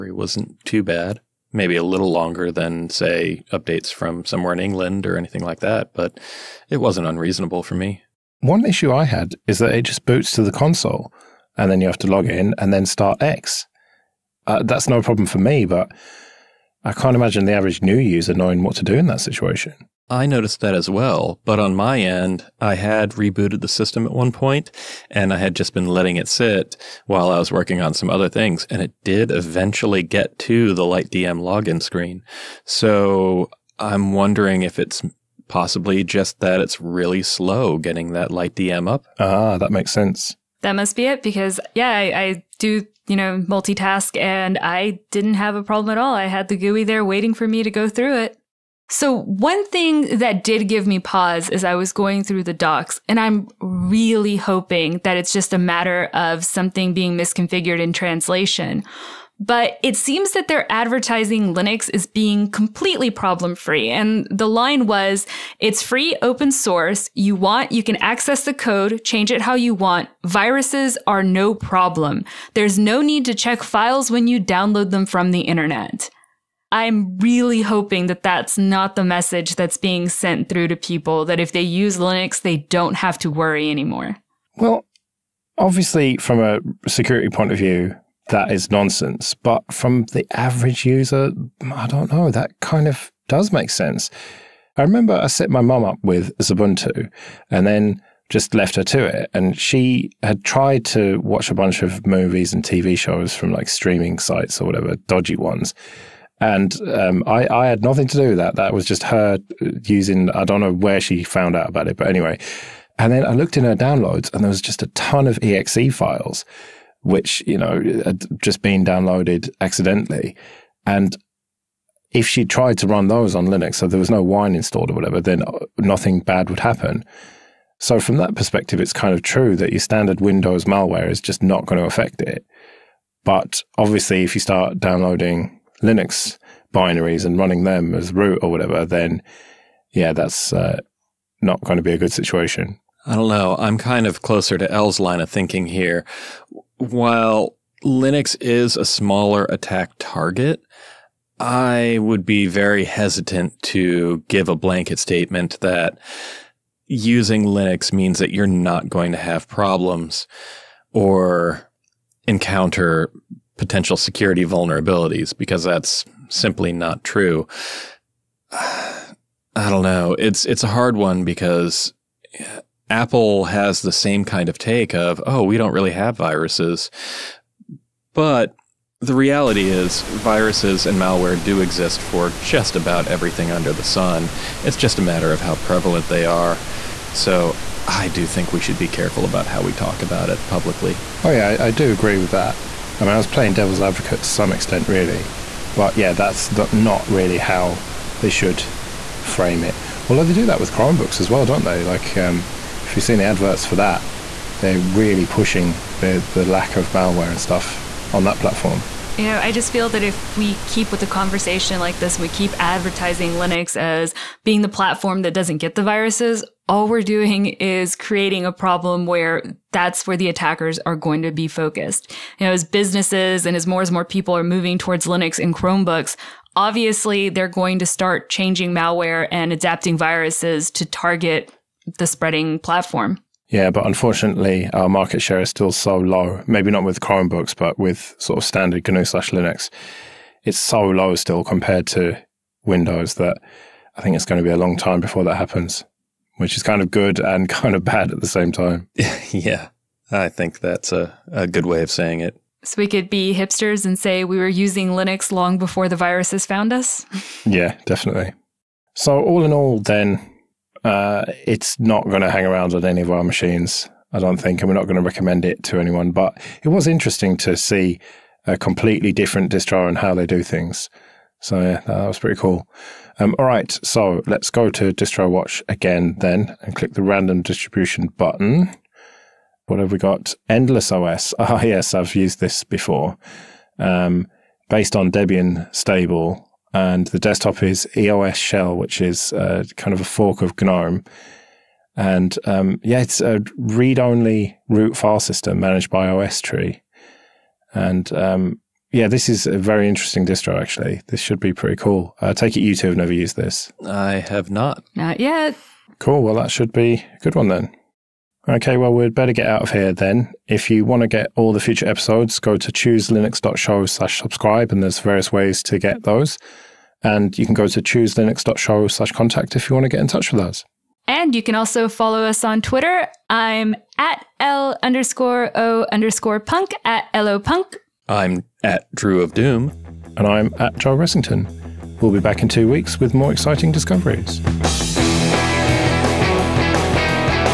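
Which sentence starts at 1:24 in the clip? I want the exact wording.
Well, obviously, from a security point of view, that is nonsense.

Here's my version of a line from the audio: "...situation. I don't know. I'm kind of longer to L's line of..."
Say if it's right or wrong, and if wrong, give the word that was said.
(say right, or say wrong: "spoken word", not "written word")
wrong: "closer", not "longer".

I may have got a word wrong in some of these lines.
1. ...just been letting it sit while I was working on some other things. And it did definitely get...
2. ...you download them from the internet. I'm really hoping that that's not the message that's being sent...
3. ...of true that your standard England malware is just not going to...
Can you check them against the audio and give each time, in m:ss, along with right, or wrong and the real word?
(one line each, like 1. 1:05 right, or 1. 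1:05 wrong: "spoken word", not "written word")
1. 0:25 wrong: "eventually", not "definitely"
2. 1:14 right
3. 2:09 wrong: "Windows", not "England".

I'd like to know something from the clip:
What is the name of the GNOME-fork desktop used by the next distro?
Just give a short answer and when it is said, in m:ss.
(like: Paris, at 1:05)
EOS shell, at 4:47.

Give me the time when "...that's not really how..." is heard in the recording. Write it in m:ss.
3:16.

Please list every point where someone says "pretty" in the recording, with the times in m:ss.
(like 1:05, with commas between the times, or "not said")
4:32, 5:01.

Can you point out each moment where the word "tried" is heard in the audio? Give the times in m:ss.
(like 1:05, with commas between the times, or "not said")
1:40, 2:02.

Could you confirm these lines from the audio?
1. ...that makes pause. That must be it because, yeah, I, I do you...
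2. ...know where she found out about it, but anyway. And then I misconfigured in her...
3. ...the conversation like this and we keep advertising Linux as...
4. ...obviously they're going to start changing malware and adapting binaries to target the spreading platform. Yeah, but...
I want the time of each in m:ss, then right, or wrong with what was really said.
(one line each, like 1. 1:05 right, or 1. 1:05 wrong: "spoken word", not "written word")
1. 0:39 wrong: "sense", not "pause"
2. 1:50 wrong: "looked", not "misconfigured"
3. 3:30 right
4. 3:46 wrong: "viruses", not "binaries".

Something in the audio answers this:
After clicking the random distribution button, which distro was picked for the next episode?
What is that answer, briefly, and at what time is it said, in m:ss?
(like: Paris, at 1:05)
Endless OS, at 4:40.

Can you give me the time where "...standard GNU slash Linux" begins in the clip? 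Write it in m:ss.
3:58.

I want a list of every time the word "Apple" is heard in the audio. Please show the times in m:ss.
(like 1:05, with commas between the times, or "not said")
2:52.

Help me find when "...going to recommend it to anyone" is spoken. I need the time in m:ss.
4:24.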